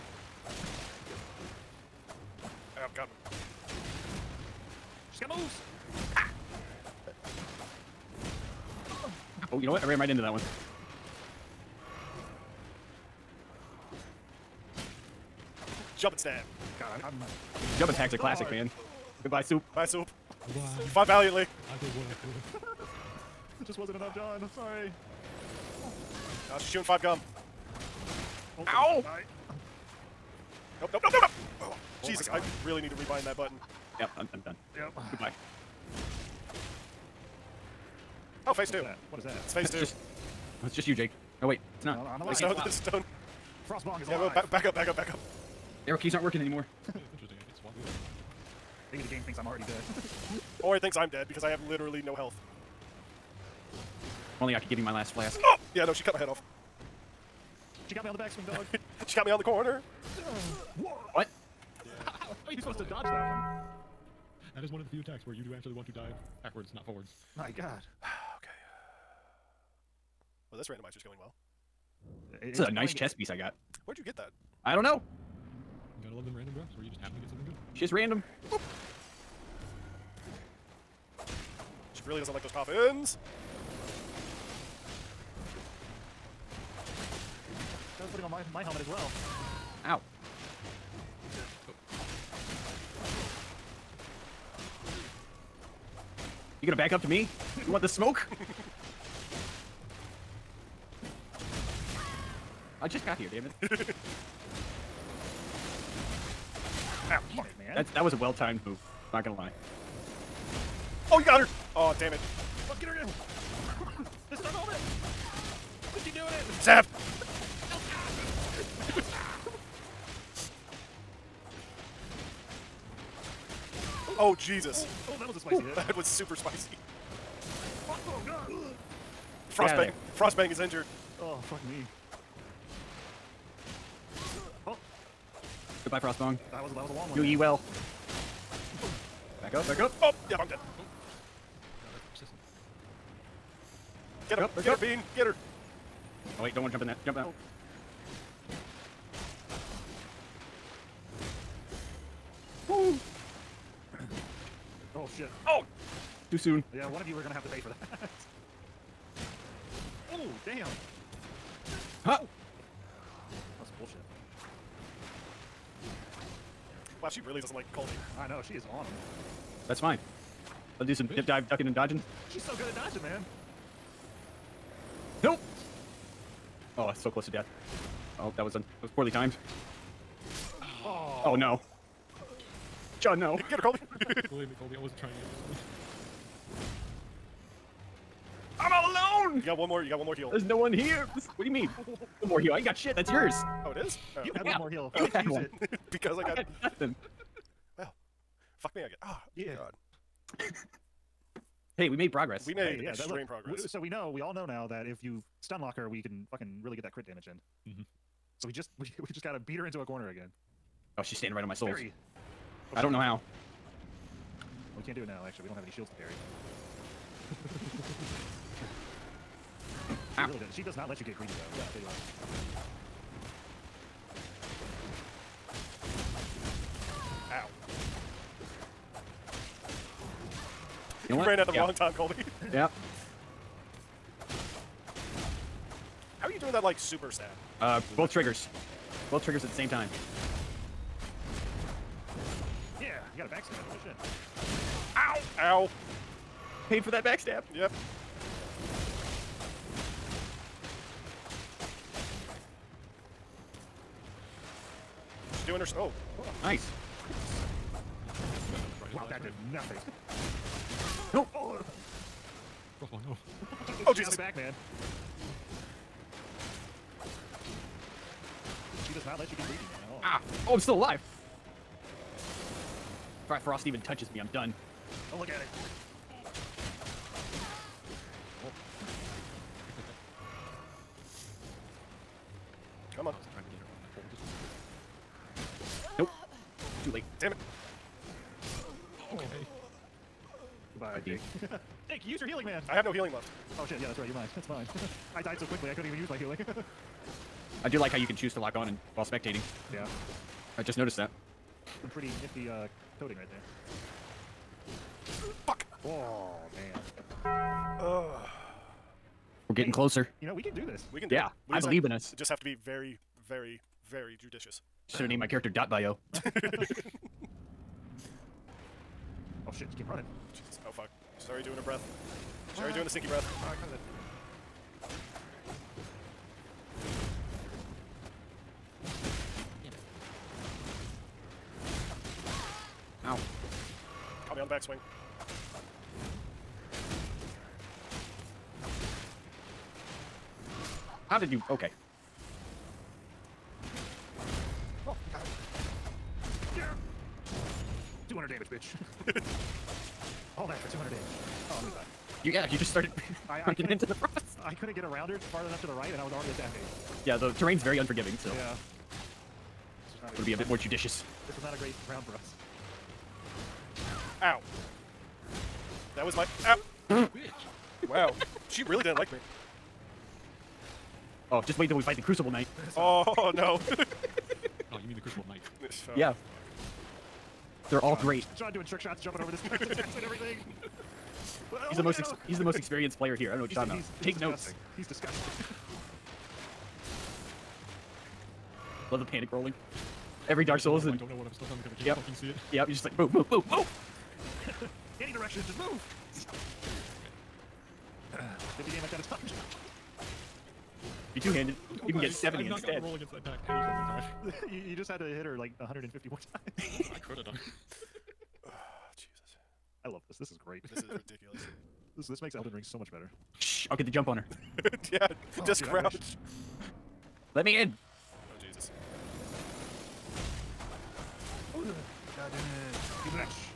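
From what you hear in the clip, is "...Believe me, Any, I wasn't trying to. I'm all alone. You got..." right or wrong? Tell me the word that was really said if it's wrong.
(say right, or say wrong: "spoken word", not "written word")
wrong: "Colby", not "Any".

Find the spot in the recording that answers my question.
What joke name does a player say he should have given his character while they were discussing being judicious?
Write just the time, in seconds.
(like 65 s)
315 s.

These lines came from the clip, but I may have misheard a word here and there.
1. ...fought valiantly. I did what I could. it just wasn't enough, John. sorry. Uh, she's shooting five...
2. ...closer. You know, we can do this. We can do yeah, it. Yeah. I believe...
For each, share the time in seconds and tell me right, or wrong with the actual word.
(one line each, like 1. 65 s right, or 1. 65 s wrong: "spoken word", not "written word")
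1. 20 s right
2. 309 s right.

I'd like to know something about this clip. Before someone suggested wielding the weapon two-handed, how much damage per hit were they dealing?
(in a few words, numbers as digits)
50.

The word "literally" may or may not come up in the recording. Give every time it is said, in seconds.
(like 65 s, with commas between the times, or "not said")
51 s.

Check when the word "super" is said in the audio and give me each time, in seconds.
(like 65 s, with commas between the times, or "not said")
126 s, 236 s.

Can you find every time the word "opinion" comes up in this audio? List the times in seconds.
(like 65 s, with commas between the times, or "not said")
not said.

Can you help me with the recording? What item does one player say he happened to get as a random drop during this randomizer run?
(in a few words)
chess piece.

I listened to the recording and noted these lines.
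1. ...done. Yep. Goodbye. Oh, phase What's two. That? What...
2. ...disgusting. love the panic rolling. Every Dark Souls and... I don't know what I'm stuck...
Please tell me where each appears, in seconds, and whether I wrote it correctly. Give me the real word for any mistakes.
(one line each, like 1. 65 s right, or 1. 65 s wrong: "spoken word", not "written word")
1. 34 s right
2. 384 s right.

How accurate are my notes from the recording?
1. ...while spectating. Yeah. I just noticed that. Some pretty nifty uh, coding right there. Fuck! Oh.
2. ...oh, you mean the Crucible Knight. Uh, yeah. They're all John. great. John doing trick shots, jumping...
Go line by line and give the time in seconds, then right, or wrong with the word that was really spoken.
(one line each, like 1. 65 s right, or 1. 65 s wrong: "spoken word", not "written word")
1. 298 s right
2. 373 s right.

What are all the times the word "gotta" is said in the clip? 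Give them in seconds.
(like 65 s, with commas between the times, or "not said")
76 s, 209 s.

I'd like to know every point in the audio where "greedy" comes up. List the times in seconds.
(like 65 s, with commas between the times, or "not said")
221 s, 269 s.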